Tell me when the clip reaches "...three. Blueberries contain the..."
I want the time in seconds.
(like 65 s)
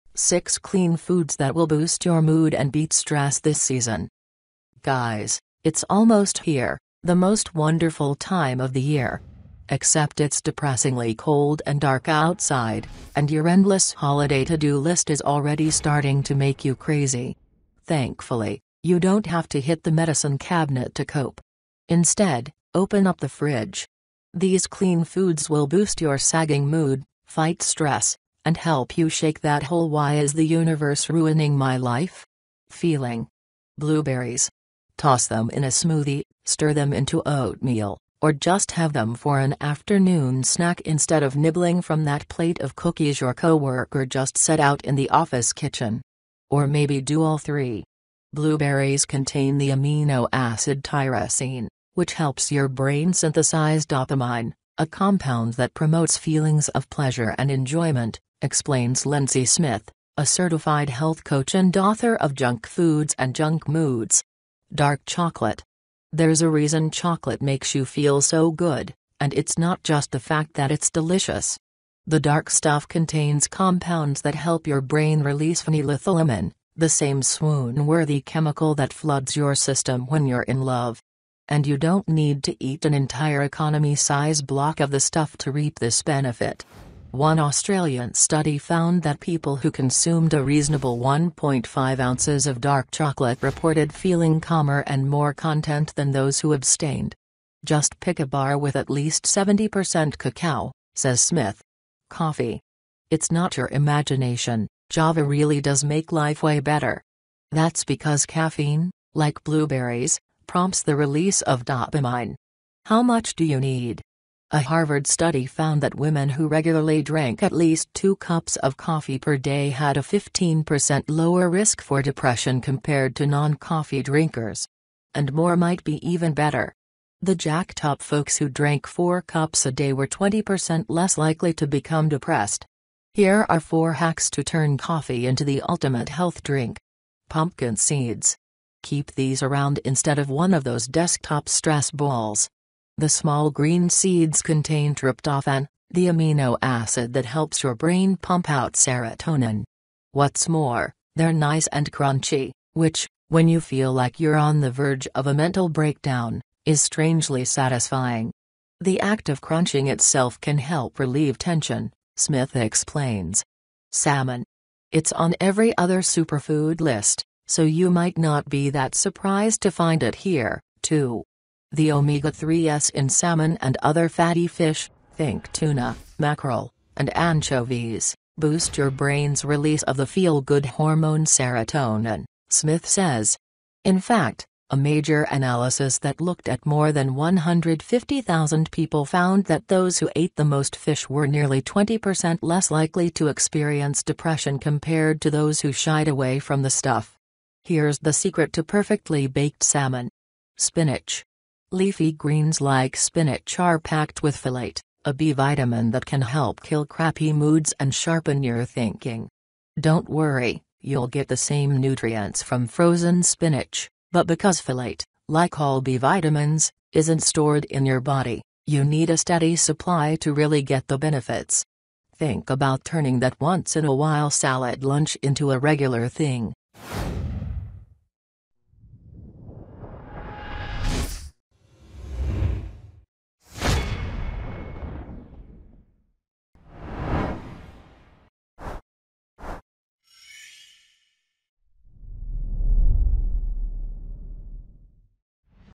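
47 s.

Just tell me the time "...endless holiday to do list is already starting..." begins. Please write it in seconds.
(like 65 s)
13 s.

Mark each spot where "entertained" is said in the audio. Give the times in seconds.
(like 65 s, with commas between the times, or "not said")
not said.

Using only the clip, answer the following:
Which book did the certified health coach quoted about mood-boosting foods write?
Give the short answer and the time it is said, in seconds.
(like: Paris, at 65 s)
Junk Foods and Junk Moods, at 62 s.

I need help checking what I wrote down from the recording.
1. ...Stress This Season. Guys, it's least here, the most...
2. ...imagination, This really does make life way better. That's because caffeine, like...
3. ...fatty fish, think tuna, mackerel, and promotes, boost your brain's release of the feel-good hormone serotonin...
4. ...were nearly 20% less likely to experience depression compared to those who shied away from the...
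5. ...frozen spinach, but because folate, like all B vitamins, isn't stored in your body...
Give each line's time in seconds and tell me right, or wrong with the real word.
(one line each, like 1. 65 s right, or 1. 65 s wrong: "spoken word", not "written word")
1. 2 s wrong: "almost", not "least"
2. 103 s wrong: "Java", not "This"
3. 174 s wrong: "anchovies", not "promotes"
4. 191 s right
5. 212 s right.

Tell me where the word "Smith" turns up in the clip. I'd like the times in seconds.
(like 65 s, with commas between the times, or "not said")
59 s, 101 s, 162 s, 182 s.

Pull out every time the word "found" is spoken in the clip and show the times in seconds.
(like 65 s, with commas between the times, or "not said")
88 s, 115 s, 189 s.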